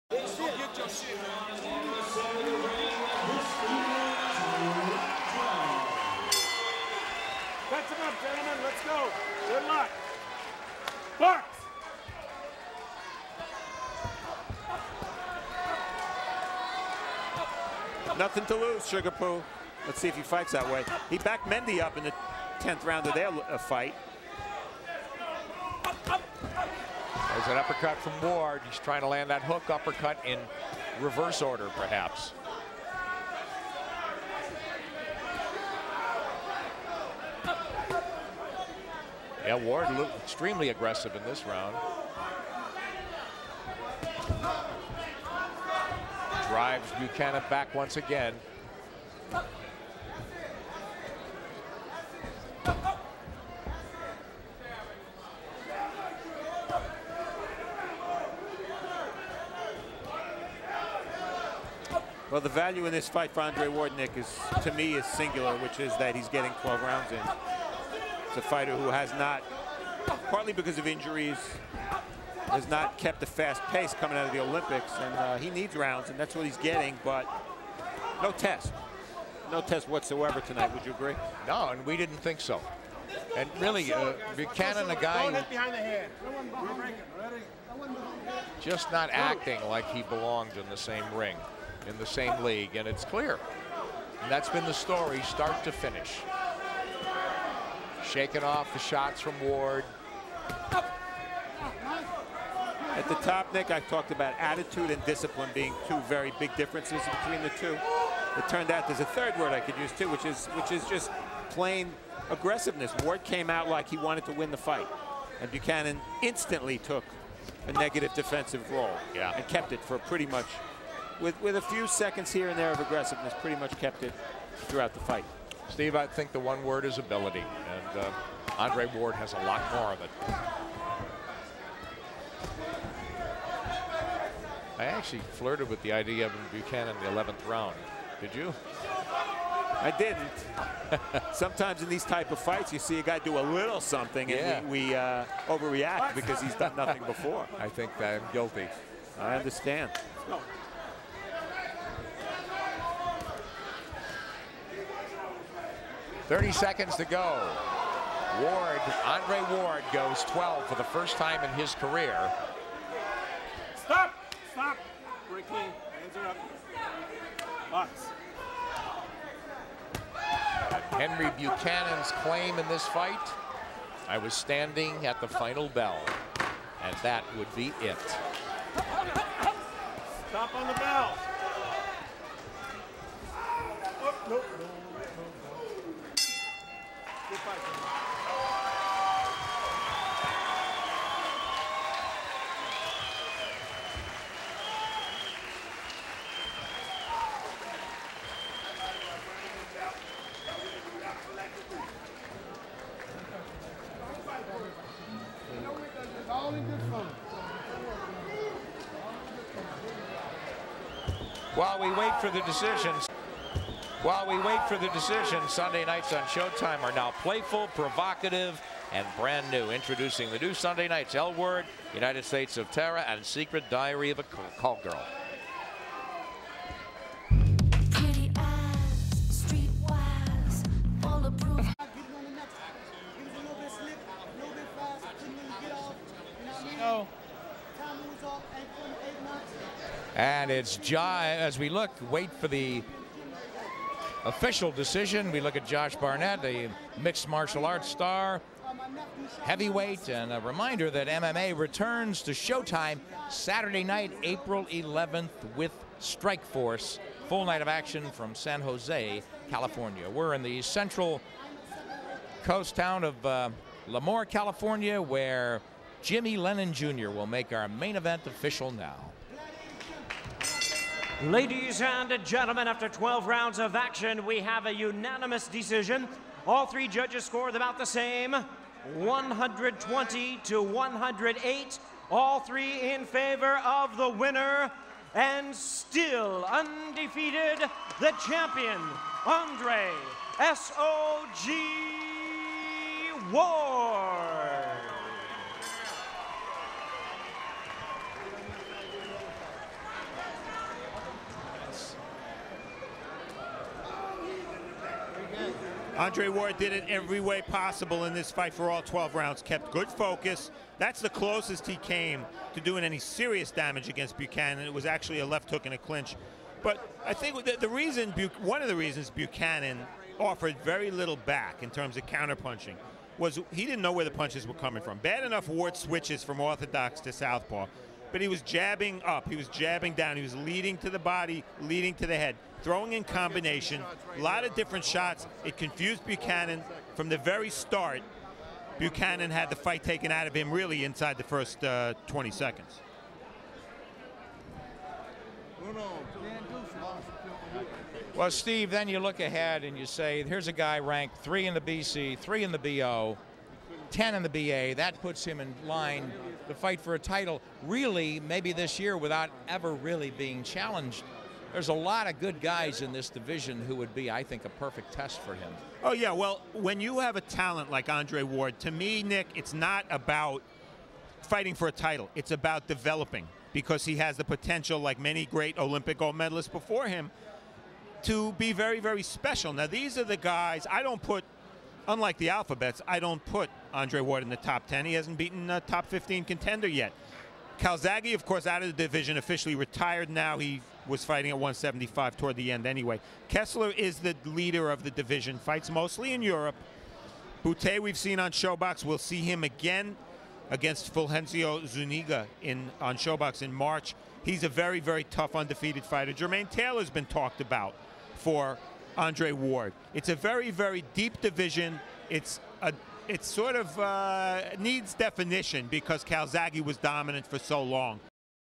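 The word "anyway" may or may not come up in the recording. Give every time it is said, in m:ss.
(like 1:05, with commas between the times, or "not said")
6:32.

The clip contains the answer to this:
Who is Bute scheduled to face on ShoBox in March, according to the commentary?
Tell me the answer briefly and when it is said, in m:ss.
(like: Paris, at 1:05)
Fulgencio Zuniga, at 6:40.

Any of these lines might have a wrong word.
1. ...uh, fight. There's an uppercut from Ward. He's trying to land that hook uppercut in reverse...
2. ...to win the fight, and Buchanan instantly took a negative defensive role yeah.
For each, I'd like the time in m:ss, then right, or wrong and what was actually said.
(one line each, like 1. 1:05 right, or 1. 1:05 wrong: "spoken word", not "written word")
1. 0:23 right
2. 1:54 right.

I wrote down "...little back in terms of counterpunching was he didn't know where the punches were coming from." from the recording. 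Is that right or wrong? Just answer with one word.
right.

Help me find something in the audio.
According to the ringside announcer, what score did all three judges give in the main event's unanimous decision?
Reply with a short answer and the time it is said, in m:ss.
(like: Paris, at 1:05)
120 to 108, at 4:38.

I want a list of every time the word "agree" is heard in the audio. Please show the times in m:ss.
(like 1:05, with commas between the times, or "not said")
1:20.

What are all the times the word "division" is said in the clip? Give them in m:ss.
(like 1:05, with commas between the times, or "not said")
6:03, 6:28, 6:34, 6:51.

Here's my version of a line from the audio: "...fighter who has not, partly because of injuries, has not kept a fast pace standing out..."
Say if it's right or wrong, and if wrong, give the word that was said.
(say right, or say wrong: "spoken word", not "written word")
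wrong: "coming", not "standing".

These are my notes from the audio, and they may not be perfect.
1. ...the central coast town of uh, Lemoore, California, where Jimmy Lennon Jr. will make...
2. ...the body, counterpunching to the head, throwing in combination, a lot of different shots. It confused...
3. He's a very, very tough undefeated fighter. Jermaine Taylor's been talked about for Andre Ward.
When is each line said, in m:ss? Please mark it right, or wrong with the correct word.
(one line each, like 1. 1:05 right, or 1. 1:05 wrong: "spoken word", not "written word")
1. 4:20 right
2. 5:30 wrong: "leading", not "counterpunching"
3. 6:44 right.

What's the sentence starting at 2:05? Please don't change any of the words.
Steve, I think the one word is ability, and uh, Andre Ward has a lot more of it.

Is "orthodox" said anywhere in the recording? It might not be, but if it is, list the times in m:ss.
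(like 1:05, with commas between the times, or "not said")
5:26.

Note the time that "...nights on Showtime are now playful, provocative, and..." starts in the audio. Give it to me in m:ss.
3:35.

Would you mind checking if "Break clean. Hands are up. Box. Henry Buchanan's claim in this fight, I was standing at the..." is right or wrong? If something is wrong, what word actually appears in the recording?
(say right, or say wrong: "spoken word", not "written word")
right.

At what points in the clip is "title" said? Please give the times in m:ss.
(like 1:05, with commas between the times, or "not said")
5:56, 6:11.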